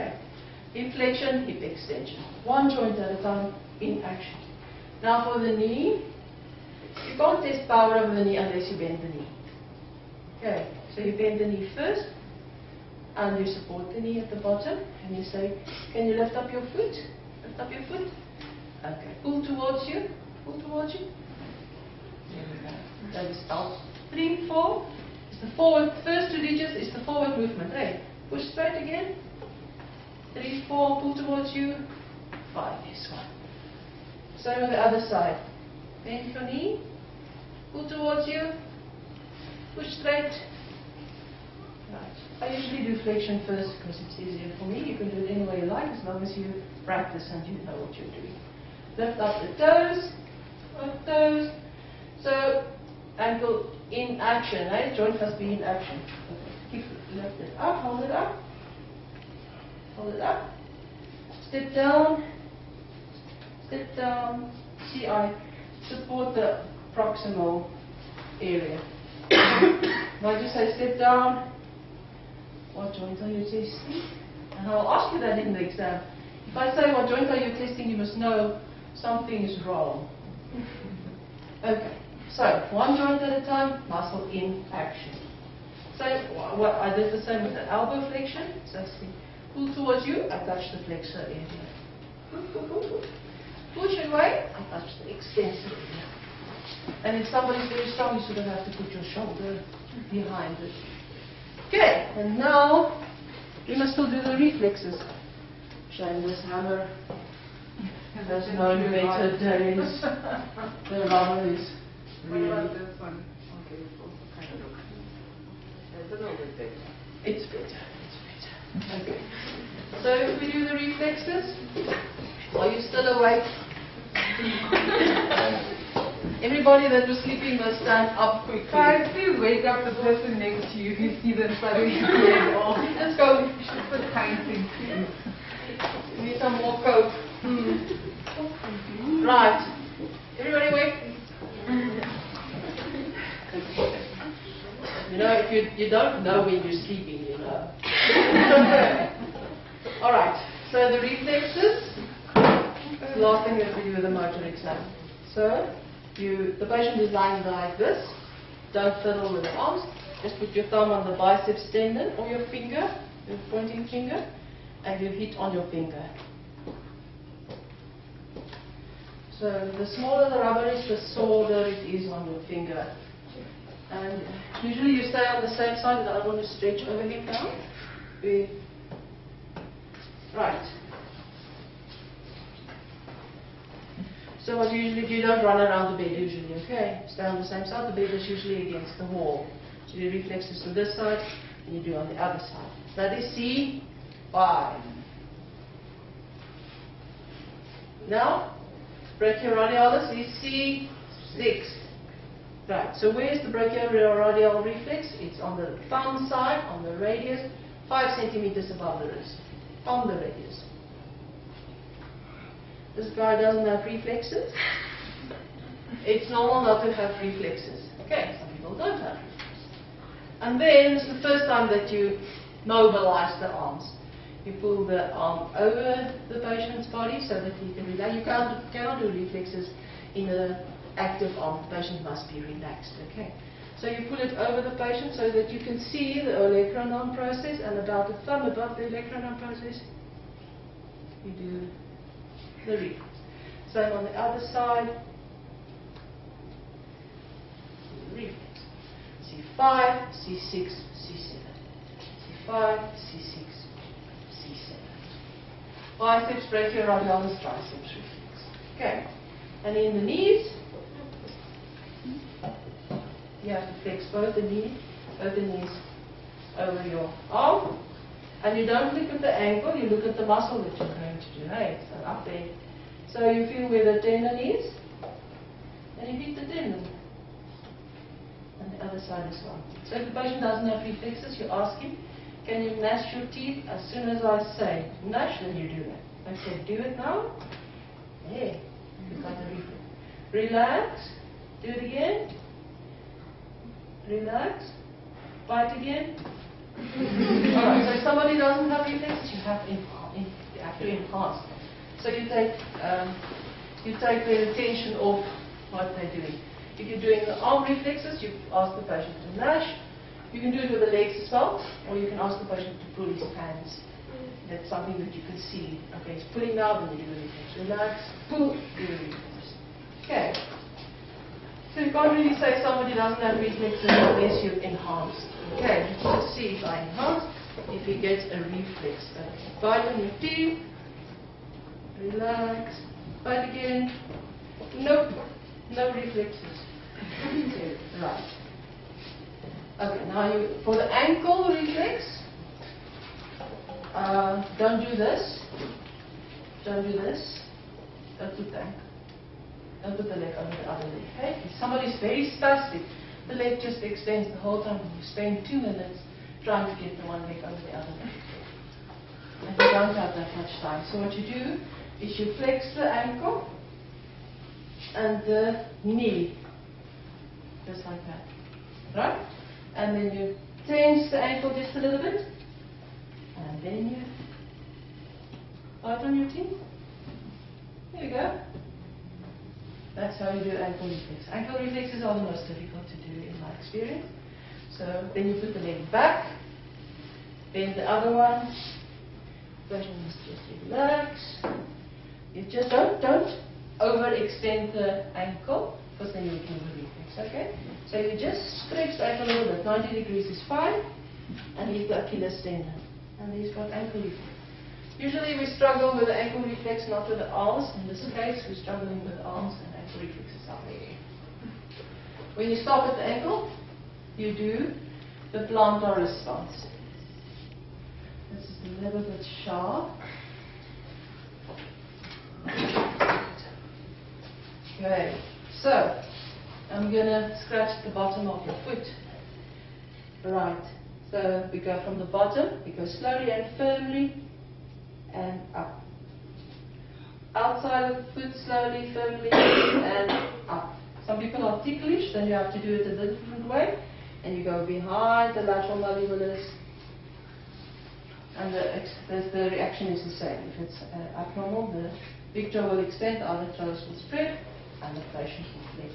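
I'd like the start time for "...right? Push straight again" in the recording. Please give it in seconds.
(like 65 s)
27 s.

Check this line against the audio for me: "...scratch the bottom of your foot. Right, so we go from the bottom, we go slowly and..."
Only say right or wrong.
right.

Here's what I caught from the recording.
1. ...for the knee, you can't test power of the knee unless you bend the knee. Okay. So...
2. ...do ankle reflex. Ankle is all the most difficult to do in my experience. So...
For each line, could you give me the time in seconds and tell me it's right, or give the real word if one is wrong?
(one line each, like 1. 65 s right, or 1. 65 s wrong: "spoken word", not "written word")
1. 5 s right
2. 380 s right.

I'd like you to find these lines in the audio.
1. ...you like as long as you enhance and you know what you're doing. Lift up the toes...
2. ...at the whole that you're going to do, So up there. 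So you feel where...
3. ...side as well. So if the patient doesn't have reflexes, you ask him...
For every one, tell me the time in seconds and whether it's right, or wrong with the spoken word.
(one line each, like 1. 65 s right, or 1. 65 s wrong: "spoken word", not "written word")
1. 45 s wrong: "practice", not "enhance"
2. 270 s wrong: "muscle", not "whole"
3. 278 s right.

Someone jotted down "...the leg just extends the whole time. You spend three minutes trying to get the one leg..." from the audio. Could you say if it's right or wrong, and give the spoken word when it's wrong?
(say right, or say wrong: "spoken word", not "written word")
wrong: "two", not "three".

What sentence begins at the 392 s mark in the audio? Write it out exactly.
You just don't, don't overextend the ankle because then you can reflex, okay?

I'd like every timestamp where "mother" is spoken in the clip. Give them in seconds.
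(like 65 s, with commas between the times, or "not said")
not said.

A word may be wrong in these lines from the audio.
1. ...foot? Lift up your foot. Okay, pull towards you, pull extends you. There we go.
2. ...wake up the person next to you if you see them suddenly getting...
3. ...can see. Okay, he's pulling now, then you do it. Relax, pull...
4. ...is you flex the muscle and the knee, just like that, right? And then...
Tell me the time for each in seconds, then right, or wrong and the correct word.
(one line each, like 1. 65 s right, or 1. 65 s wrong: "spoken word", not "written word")
1. 16 s wrong: "towards", not "extends"
2. 129 s right
3. 315 s right
4. 362 s wrong: "ankle", not "muscle".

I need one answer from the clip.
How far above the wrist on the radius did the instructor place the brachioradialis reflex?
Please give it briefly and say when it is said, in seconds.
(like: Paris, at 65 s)
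5 centimeters, at 207 s.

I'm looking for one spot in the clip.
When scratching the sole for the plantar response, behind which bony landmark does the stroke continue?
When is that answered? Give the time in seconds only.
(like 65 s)
445 s.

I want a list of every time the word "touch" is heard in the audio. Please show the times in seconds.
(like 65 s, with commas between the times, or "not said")
90 s, 94 s.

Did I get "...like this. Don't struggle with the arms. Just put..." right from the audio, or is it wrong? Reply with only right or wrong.
wrong.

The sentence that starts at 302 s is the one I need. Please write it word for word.
So you take, um, you take the attention off what they're doing.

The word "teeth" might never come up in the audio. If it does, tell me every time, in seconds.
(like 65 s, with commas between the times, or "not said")
283 s, 330 s, 376 s.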